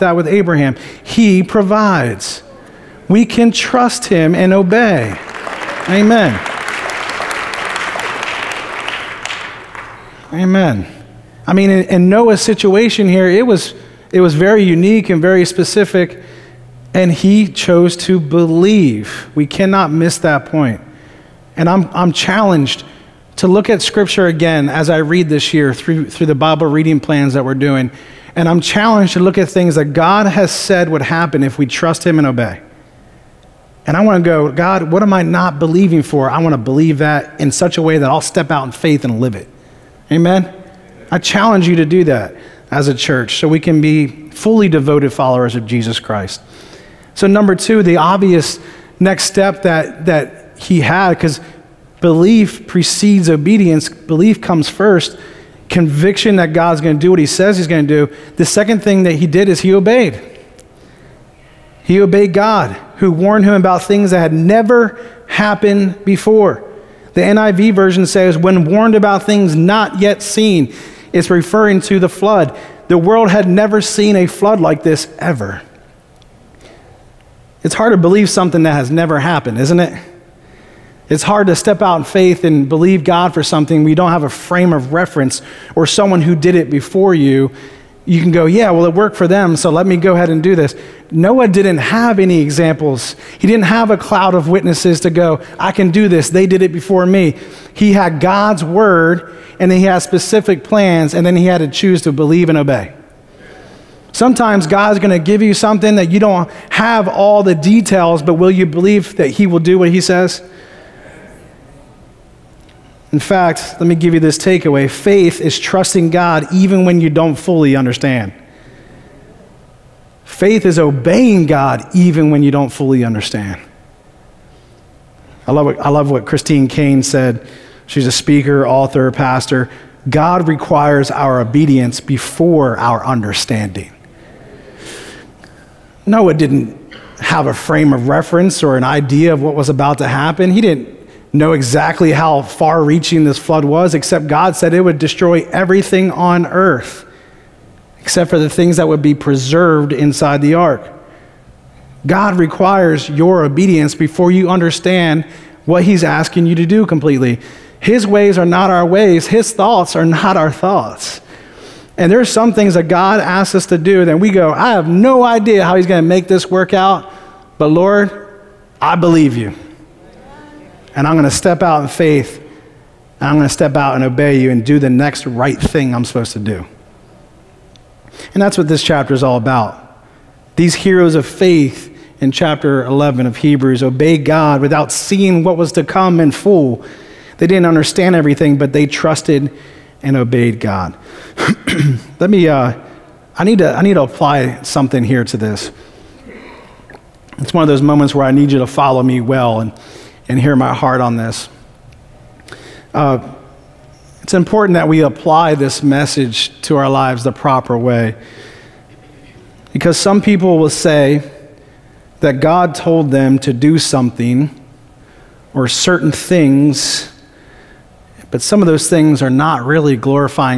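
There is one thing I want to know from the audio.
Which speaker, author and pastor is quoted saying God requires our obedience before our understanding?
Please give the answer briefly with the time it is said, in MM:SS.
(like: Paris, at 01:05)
Christine Caine, at 02:06.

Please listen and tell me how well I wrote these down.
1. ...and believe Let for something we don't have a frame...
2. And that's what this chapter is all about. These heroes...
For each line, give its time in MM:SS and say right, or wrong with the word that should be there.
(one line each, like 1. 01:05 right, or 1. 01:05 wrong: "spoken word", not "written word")
1. 01:22 wrong: "God", not "Let"
2. 02:58 right.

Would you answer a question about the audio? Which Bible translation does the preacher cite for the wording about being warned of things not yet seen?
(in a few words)
NIV.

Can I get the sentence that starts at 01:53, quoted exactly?
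In fact, let me give you this takeaway faith is trusting God even when you don't fully understand.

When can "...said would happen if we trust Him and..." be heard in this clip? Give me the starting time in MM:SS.
00:30.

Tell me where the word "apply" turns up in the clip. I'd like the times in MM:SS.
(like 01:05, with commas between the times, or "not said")
03:14, 03:25.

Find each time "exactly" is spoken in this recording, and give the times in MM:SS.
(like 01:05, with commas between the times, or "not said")
02:21.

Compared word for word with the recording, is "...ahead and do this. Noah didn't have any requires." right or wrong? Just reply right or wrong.
wrong.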